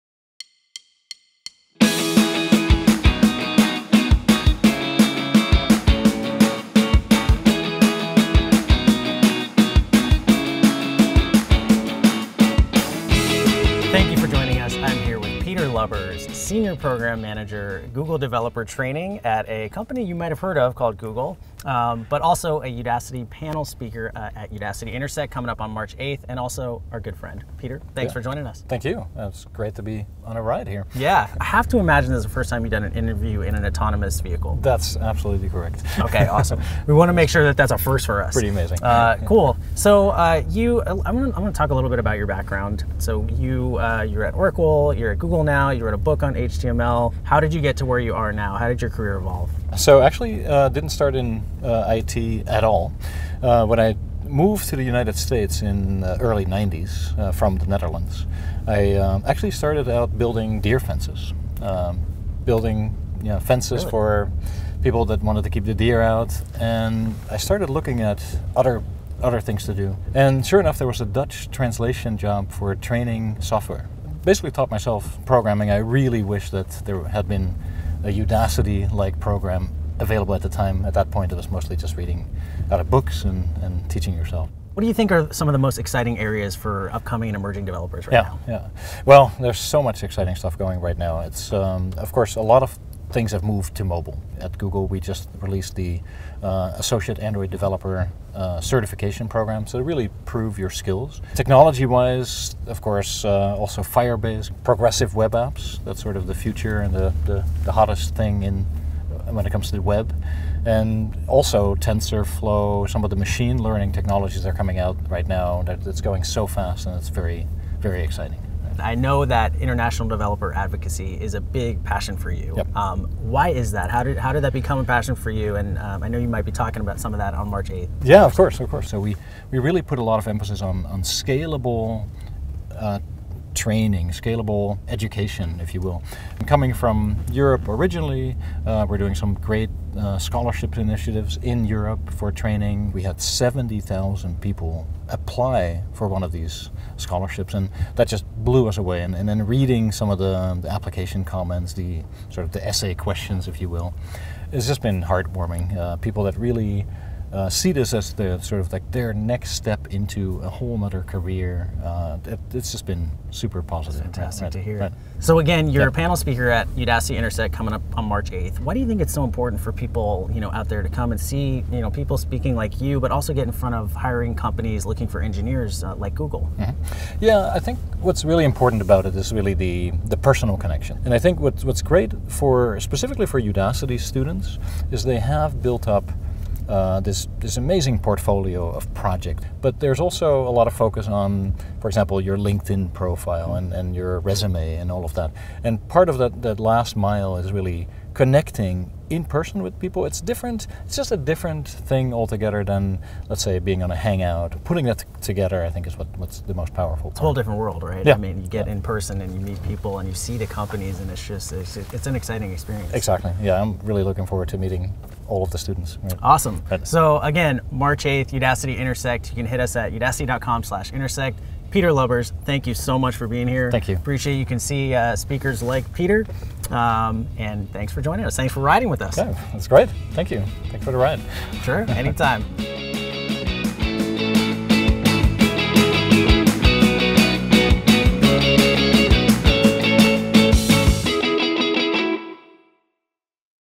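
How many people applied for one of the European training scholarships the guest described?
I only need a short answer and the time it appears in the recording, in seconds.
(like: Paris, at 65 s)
70,000, at 143 s.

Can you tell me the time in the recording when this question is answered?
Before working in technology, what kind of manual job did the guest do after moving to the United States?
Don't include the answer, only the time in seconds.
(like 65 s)
60 s.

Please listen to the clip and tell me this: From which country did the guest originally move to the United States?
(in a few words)
Netherlands.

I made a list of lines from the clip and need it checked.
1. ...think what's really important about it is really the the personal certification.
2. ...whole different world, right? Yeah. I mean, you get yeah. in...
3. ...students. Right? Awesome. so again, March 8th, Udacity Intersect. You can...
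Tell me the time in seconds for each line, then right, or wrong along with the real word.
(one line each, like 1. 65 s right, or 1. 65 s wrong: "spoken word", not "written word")
1. 177 s wrong: "connection", not "certification"
2. 207 s right
3. 215 s right.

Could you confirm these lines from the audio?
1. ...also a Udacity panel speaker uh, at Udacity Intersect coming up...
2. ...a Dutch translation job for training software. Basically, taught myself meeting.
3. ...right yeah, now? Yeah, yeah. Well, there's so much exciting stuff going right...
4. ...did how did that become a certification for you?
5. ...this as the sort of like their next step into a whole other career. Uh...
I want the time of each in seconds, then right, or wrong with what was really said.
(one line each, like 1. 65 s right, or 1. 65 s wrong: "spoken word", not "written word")
1. 22 s right
2. 70 s wrong: "programming", not "meeting"
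3. 88 s right
4. 124 s wrong: "passion", not "certification"
5. 157 s right.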